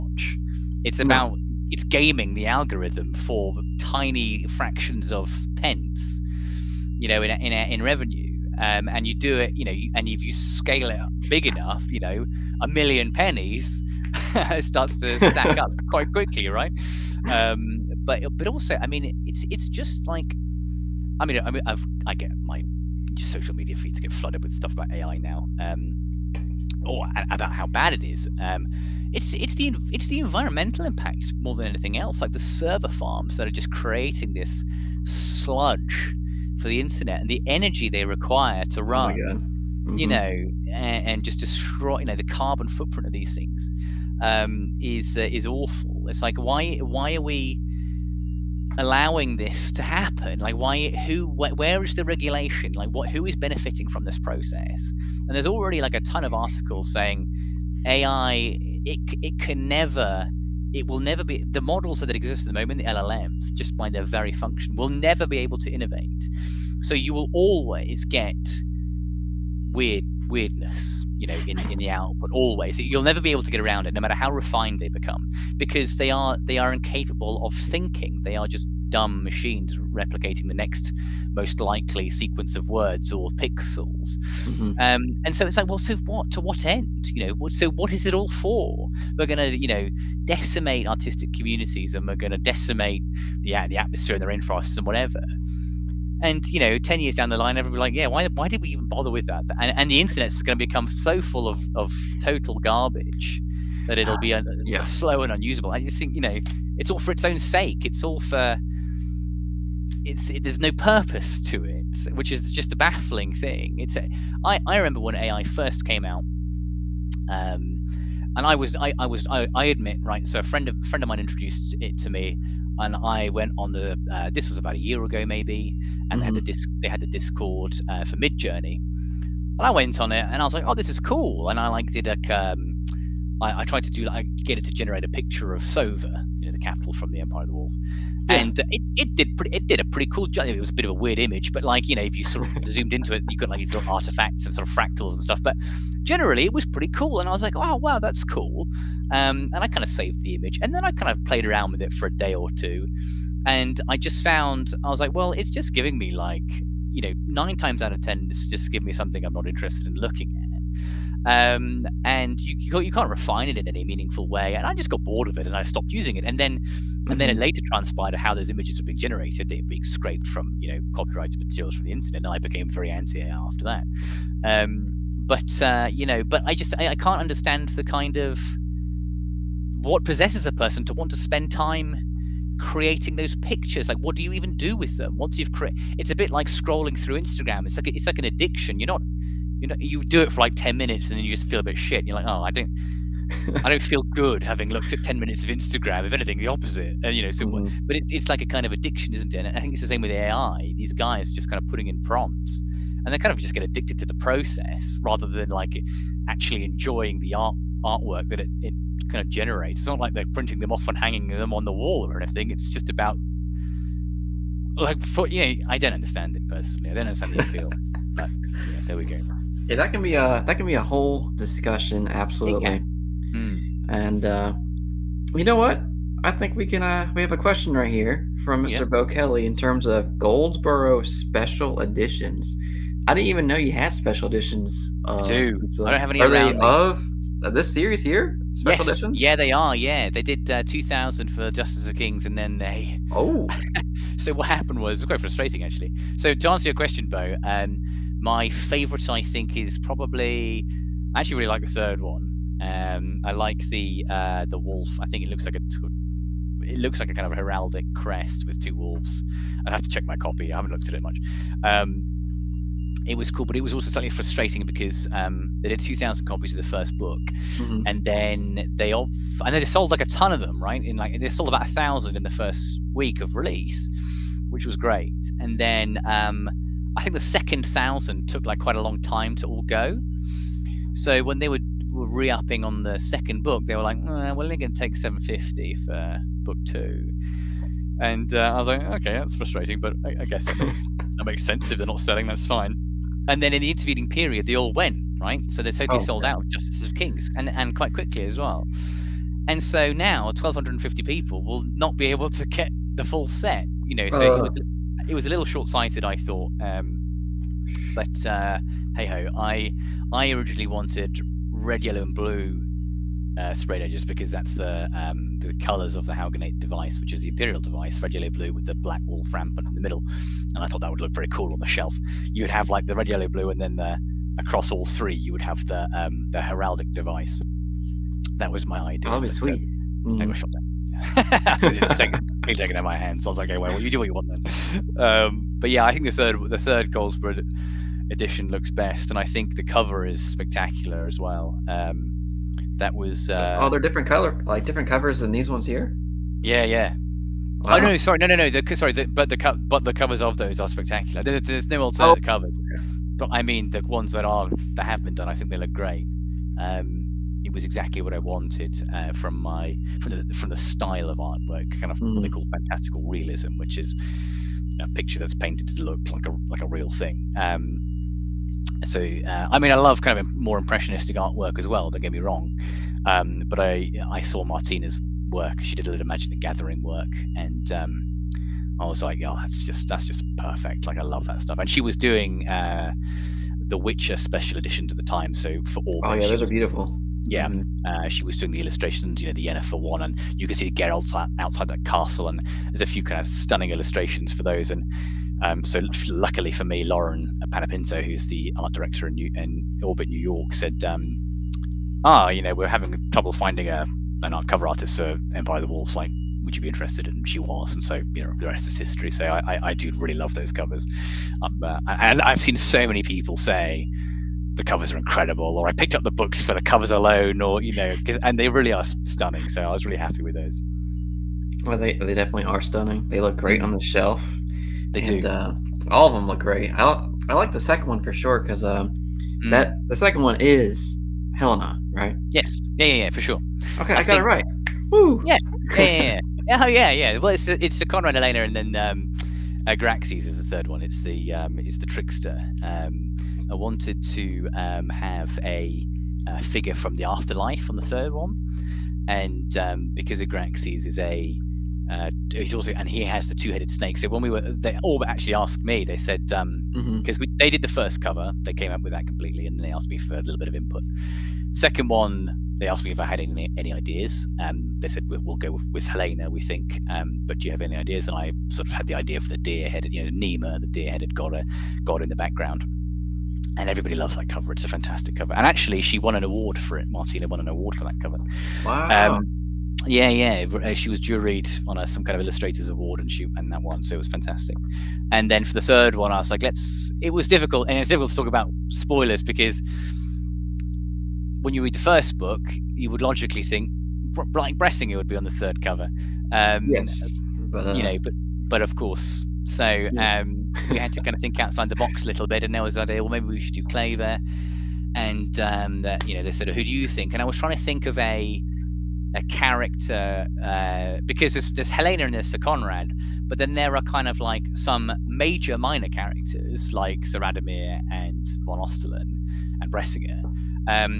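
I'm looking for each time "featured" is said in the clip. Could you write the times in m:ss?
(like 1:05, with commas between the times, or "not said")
not said.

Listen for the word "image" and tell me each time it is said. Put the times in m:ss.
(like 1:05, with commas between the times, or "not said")
2:21, 2:30, 2:48.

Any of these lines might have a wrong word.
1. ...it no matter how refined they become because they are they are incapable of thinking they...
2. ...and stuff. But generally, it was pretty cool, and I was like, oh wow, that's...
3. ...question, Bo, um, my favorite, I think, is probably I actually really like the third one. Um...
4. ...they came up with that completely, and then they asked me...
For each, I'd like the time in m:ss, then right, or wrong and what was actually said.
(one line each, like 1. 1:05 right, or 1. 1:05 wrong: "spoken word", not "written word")
1. 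1:13 right
2. 2:25 right
3. 4:06 right
4. 7:38 right.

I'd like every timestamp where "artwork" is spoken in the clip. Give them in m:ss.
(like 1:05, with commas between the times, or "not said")
3:27, 6:01, 6:11.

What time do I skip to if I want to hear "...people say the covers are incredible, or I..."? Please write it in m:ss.
6:53.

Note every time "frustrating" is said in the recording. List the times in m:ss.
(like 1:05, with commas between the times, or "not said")
4:05, 4:24, 4:49.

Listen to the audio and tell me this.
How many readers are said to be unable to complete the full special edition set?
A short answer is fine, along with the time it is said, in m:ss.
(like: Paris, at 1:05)
1,250, at 5:00.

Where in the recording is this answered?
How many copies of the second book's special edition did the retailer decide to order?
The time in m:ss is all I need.
4:44.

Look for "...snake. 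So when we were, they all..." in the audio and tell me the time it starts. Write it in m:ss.
7:33.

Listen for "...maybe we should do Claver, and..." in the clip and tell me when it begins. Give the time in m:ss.
8:23.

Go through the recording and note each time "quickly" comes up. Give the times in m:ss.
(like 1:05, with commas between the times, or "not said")
0:16, 4:57.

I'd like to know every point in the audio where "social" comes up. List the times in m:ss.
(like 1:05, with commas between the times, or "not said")
0:23.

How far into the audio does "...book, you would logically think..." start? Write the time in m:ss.
8:12.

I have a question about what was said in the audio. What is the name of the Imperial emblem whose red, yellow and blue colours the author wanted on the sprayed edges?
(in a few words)
Haugenate device.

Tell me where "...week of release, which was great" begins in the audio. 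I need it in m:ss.
4:32.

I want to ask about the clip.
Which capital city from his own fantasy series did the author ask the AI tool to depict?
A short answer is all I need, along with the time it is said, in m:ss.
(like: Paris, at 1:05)
Sova, at 2:15.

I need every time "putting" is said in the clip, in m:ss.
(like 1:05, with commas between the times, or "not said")
3:21.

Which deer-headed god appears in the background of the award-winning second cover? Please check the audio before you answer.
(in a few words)
Nema.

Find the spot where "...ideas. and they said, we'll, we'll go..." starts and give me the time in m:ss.
7:43.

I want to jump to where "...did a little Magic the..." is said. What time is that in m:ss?
6:15.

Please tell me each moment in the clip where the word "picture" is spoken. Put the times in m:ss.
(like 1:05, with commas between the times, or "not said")
2:15, 3:03, 6:04.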